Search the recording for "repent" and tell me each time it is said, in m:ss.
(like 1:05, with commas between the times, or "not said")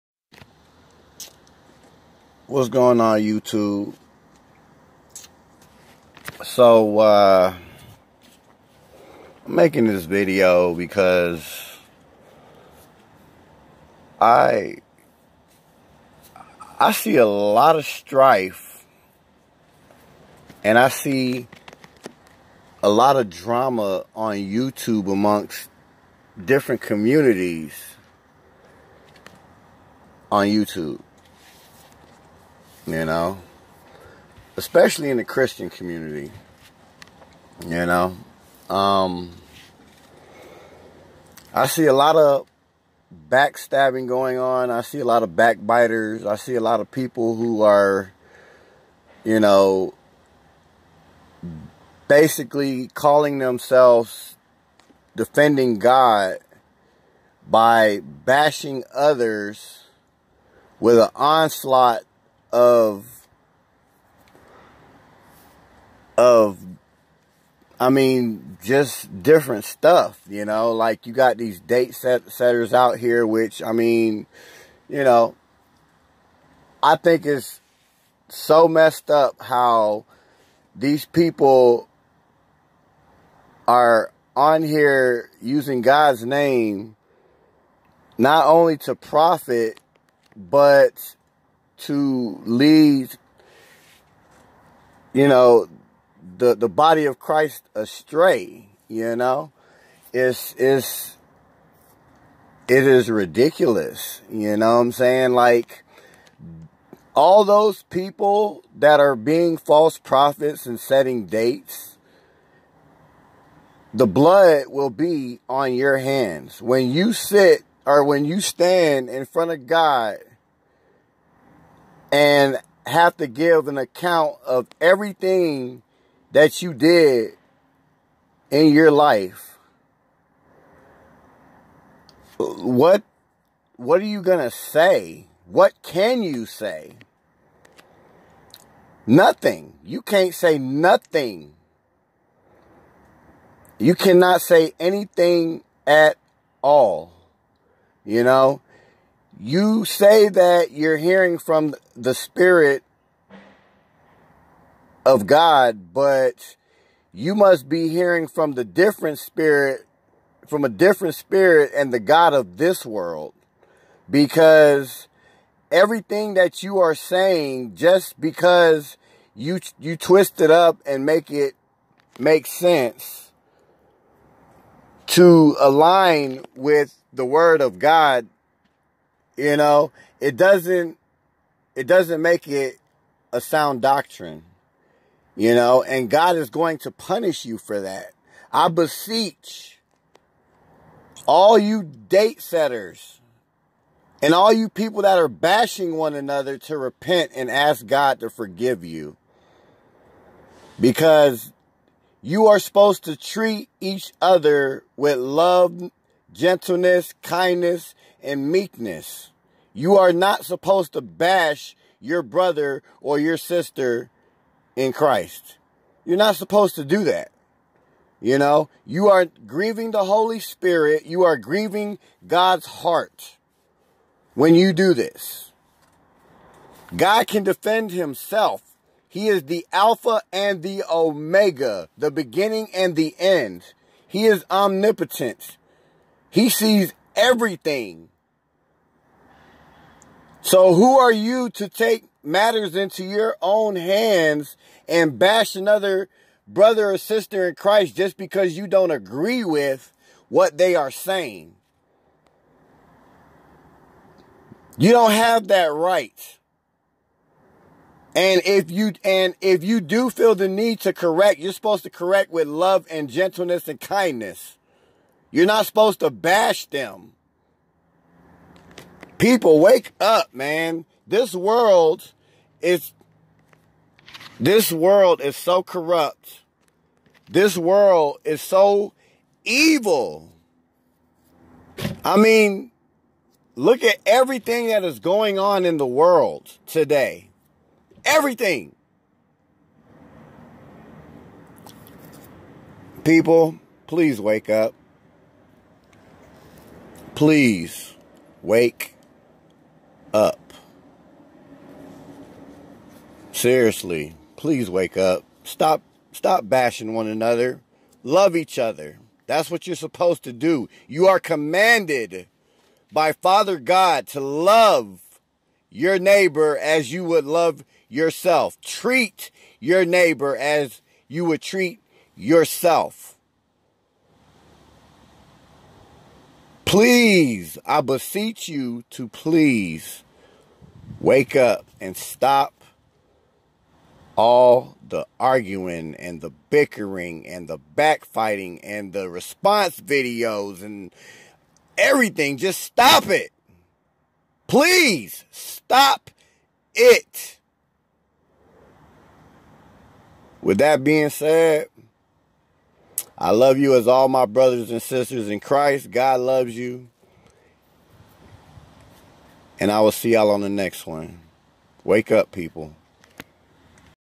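3:16.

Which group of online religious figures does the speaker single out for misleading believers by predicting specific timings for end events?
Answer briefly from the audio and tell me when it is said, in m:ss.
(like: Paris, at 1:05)
date setters, at 1:11.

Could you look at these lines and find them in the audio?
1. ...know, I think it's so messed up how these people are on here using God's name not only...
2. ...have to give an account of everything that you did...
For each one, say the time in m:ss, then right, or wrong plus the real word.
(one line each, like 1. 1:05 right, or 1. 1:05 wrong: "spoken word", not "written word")
1. 1:15 right
2. 2:02 right.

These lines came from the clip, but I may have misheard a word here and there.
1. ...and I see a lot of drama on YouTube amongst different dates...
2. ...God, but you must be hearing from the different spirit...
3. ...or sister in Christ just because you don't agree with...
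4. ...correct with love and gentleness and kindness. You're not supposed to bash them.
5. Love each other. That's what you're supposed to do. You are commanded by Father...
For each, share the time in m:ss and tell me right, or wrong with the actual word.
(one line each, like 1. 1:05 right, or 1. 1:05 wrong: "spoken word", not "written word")
1. 0:20 wrong: "communities", not "dates"
2. 2:35 right
3. 4:06 right
4. 4:21 right
5. 5:08 right.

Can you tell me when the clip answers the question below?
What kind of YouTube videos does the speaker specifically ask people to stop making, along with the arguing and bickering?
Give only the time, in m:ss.
5:39.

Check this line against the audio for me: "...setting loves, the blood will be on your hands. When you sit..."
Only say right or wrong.
wrong.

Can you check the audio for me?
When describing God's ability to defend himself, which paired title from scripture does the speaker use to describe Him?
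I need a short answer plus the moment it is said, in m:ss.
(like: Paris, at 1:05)
the Alpha and the Omega, at 3:49.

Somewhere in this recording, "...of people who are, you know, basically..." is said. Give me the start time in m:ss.
0:46.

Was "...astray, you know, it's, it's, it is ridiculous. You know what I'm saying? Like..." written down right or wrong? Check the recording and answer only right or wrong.
right.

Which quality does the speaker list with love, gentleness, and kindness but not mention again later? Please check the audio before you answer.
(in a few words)
meekness.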